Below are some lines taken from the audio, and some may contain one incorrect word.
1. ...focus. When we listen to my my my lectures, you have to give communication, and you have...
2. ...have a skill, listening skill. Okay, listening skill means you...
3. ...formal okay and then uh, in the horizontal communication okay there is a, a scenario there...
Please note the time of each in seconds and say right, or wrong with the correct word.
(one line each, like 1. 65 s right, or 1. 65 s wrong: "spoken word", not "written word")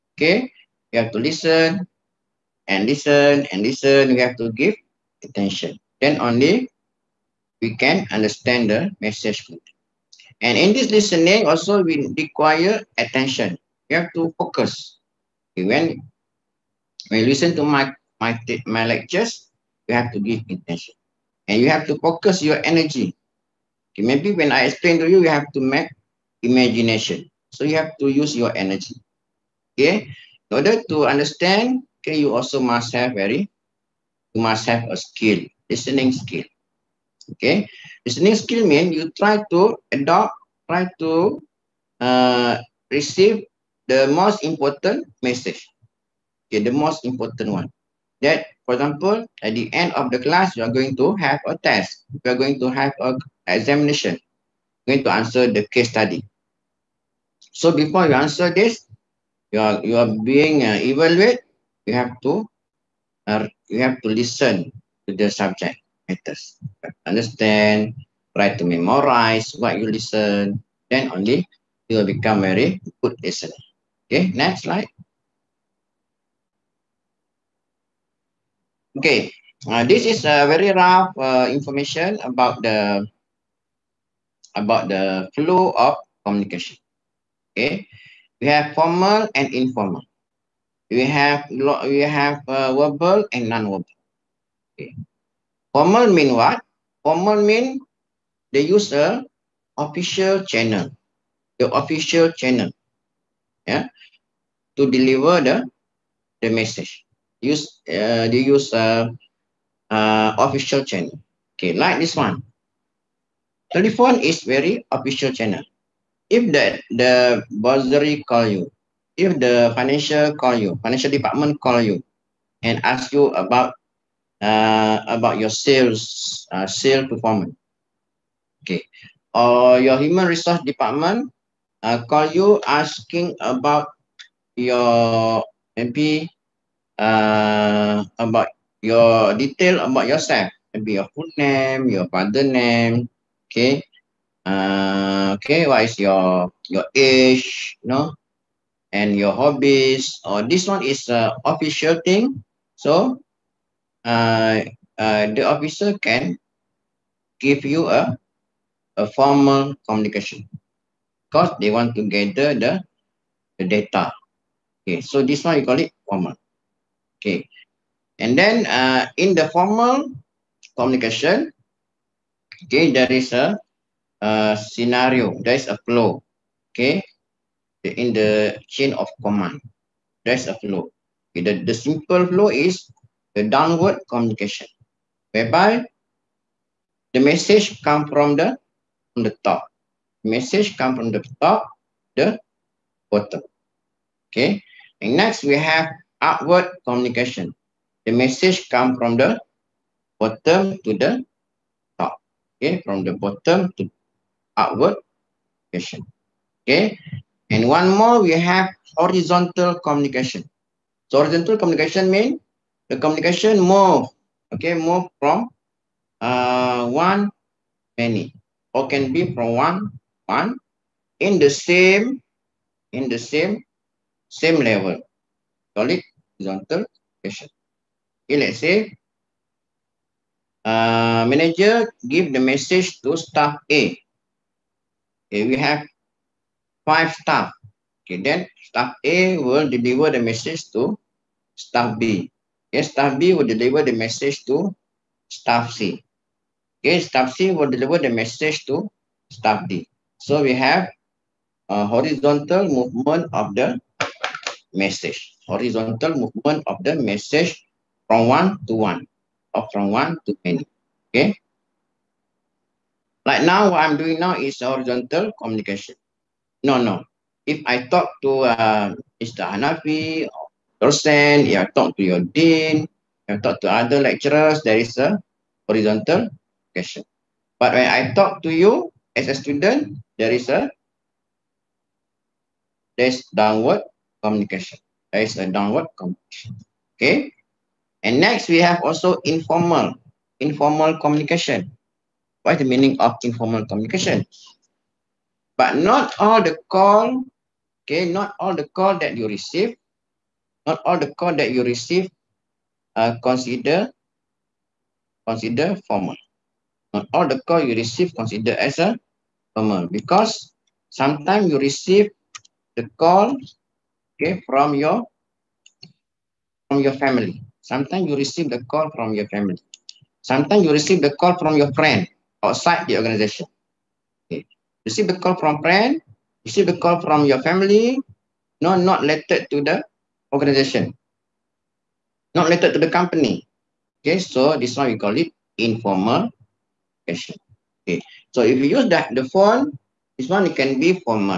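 1. 14 s wrong: "attention", not "communication"
2. 34 s right
3. 166 s wrong: "formal", not "horizontal".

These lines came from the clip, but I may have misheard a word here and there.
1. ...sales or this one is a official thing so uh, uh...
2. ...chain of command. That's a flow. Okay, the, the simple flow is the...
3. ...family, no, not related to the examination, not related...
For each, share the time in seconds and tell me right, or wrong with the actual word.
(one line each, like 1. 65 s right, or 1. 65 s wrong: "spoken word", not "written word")
1. 149 s wrong: "hobbies", not "sales"
2. 178 s right
3. 327 s wrong: "organization", not "examination".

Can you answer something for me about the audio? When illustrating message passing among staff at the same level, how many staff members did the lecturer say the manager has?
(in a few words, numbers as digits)
5.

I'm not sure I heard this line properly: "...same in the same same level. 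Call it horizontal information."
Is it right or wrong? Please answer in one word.
wrong.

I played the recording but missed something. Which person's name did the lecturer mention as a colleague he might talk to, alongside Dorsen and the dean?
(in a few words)
Mr. Hanafi.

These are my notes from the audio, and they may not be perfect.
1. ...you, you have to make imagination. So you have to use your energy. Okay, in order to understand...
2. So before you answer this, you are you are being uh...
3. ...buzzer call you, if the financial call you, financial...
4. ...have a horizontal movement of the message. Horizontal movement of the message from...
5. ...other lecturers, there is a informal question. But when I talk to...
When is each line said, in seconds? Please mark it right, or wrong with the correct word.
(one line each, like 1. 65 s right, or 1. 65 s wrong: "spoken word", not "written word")
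1. 25 s right
2. 57 s right
3. 117 s right
4. 250 s right
5. 273 s wrong: "horizontal", not "informal".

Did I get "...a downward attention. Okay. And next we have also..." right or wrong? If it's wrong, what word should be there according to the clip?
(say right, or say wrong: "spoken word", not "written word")
wrong: "communication", not "attention".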